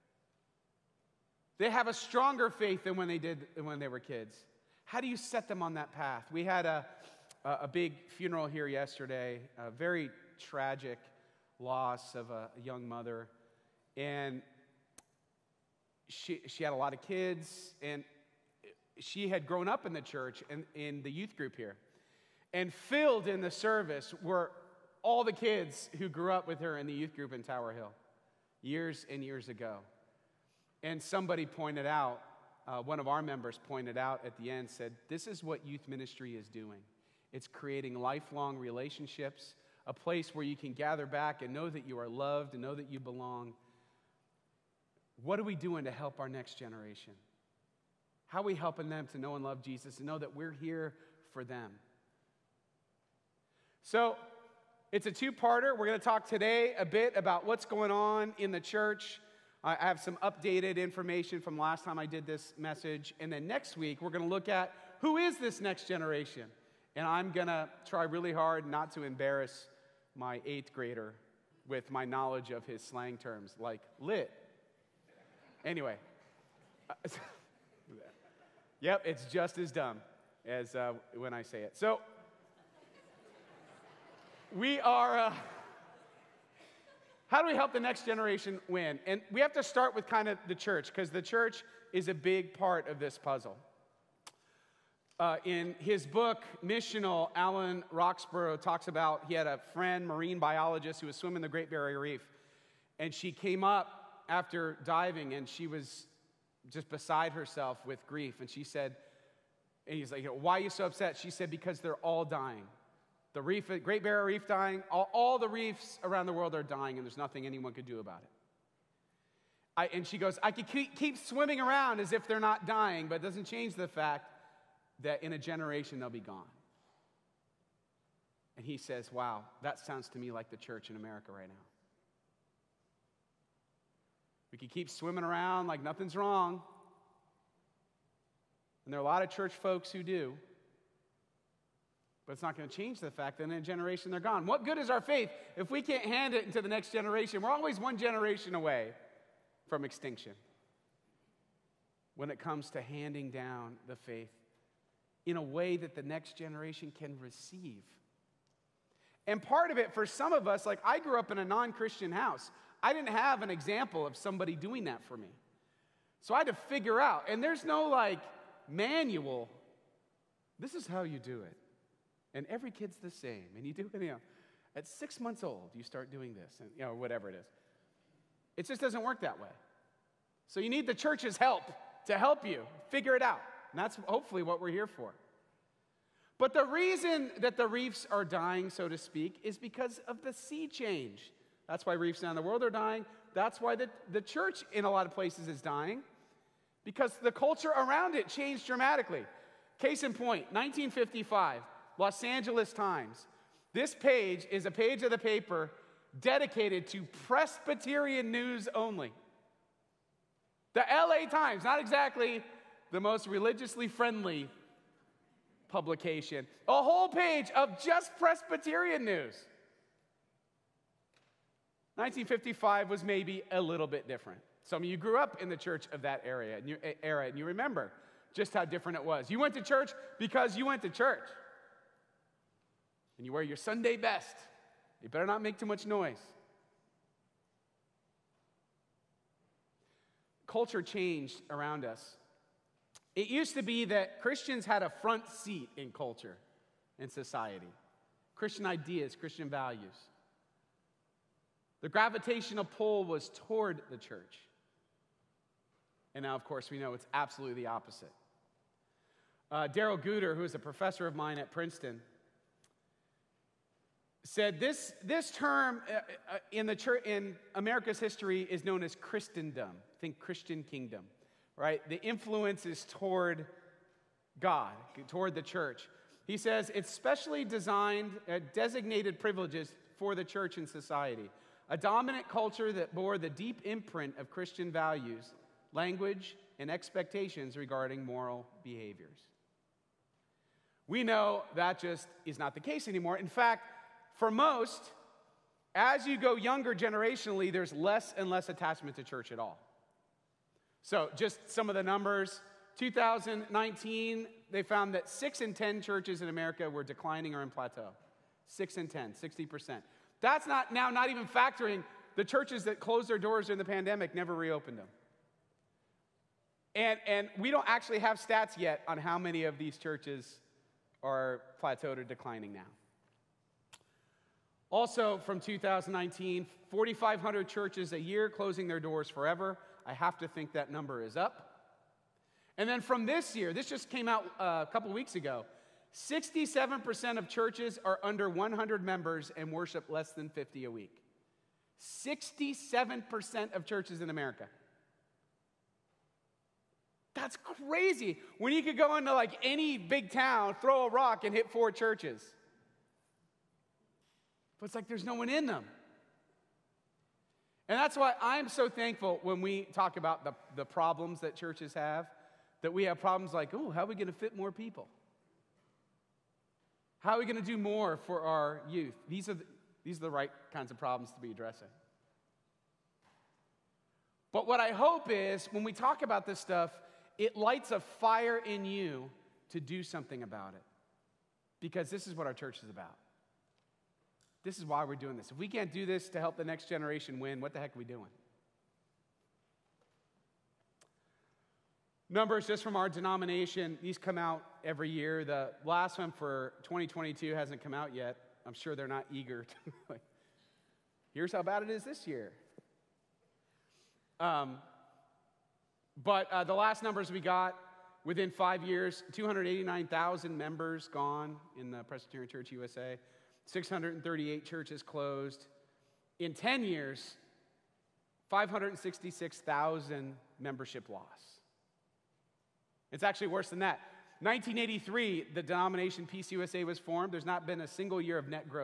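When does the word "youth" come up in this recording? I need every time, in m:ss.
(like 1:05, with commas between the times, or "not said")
0:21, 0:26, 0:35, 6:08.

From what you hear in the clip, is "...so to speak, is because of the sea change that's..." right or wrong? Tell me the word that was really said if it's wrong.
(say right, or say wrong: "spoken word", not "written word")
right.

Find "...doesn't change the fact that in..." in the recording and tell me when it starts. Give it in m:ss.
2:03.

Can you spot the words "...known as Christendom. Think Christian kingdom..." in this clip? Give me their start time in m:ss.
4:28.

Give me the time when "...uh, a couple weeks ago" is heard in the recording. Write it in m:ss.
5:34.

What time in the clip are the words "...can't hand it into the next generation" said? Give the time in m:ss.
2:25.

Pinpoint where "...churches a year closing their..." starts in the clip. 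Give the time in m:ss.
5:27.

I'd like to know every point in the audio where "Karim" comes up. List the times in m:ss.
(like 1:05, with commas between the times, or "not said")
not said.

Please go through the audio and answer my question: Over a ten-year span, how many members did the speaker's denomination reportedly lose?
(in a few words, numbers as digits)
566,000.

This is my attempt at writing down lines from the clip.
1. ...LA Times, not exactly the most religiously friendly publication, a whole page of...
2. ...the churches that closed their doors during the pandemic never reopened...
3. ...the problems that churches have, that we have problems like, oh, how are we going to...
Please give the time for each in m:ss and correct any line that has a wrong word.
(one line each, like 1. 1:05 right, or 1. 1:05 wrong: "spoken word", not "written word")
1. 3:30 right
2. 5:12 right
3. 6:00 right.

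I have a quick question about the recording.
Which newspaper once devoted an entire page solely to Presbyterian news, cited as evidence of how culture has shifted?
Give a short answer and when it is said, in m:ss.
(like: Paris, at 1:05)
Los Angeles Times, at 3:21.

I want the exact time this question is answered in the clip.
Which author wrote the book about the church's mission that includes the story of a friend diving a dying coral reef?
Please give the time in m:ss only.
1:37.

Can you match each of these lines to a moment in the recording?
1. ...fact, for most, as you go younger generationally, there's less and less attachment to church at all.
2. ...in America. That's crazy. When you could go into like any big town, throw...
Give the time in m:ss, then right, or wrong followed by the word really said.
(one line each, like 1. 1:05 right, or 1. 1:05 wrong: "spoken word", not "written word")
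1. 4:53 right
2. 5:44 right.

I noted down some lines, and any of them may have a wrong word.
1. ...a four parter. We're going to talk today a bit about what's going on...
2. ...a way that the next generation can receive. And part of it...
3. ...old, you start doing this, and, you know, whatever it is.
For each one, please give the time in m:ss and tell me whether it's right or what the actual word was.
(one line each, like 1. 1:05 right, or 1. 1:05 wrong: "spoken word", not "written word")
1. 0:55 wrong: "two", not "four"
2. 2:35 right
3. 2:55 right.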